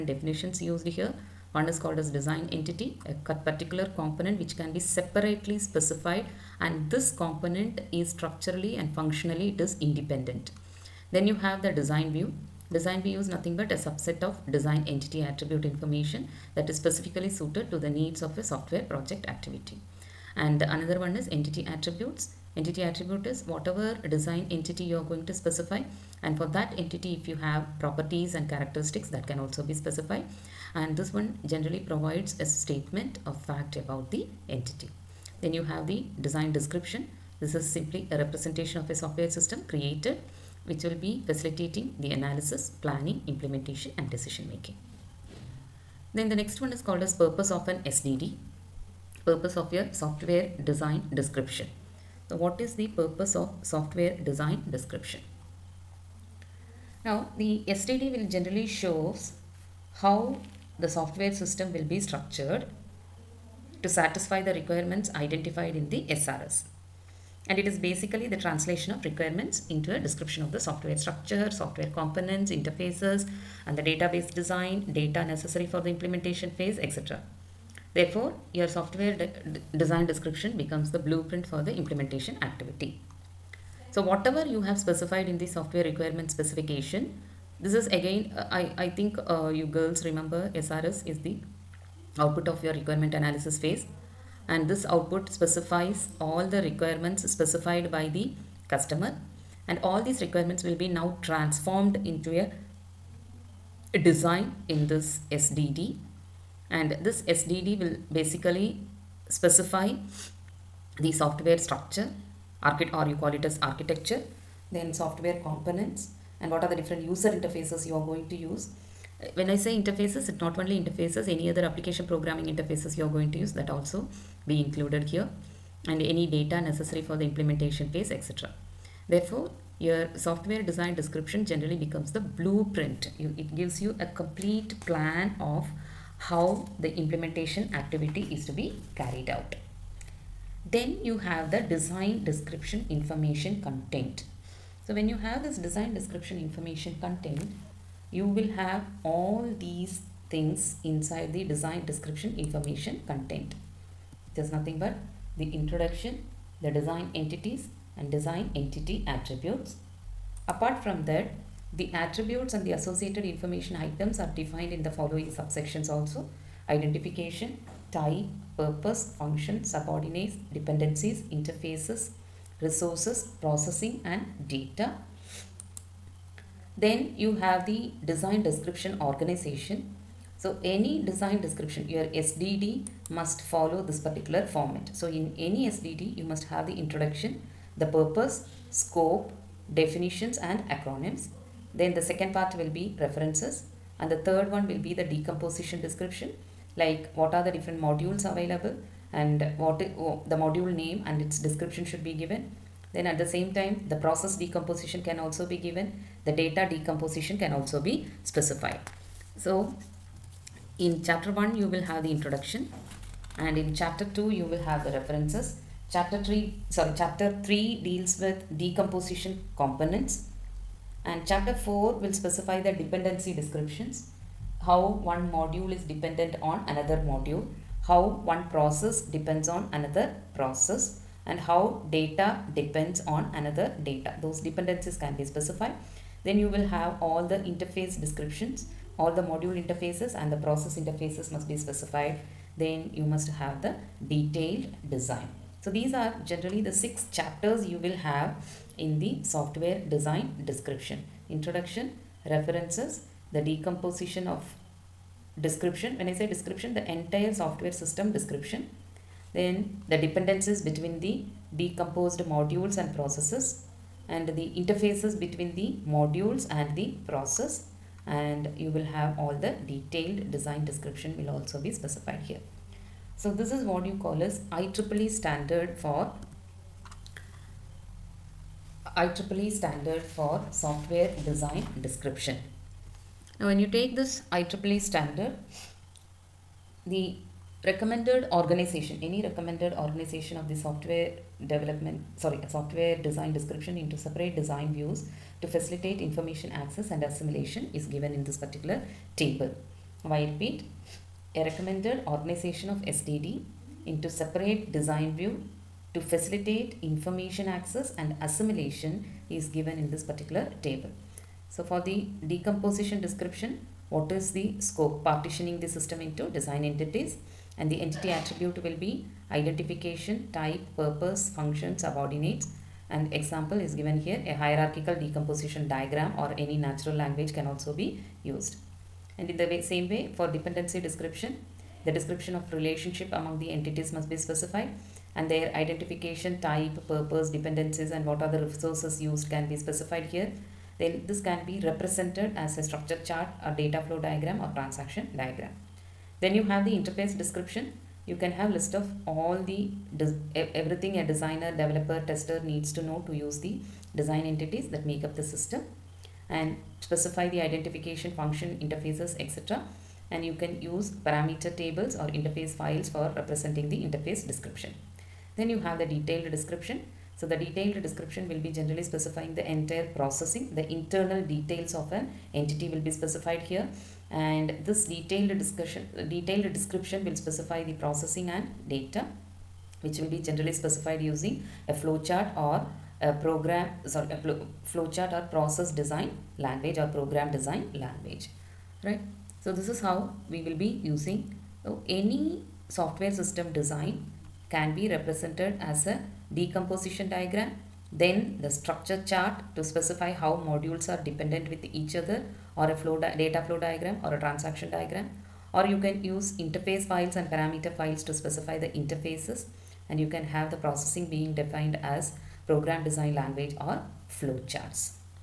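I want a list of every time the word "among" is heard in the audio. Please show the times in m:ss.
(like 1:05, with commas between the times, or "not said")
5:33.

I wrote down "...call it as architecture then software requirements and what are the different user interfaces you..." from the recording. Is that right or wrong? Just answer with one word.
wrong.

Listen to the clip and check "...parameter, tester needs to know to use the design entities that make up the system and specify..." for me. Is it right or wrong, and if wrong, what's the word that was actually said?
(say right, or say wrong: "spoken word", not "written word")
wrong: "developer", not "parameter".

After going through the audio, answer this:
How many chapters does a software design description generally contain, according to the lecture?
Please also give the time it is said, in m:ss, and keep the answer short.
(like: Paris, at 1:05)
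6, at 4:06.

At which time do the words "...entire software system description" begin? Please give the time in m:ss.
4:16.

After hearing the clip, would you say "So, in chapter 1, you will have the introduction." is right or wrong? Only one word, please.
right.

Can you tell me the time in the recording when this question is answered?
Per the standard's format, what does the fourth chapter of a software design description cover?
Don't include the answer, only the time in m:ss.
3:42.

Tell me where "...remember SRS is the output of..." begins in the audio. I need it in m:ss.
1:30.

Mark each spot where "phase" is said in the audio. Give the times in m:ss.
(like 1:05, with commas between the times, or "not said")
1:16, 1:33, 2:07.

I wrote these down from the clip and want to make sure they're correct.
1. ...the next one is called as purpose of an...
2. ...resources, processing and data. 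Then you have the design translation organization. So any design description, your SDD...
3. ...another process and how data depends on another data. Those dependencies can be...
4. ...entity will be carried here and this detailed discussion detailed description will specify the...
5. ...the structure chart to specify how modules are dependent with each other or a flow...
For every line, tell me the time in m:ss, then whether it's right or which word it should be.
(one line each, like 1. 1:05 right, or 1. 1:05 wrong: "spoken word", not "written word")
1. 0:46 right
2. 2:52 wrong: "description", not "translation"
3. 3:49 right
4. 6:12 wrong: "specified", not "carried"
5. 6:38 right.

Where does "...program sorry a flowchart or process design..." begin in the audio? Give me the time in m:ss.
6:23.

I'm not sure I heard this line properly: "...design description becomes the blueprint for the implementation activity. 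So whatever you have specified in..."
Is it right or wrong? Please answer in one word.
right.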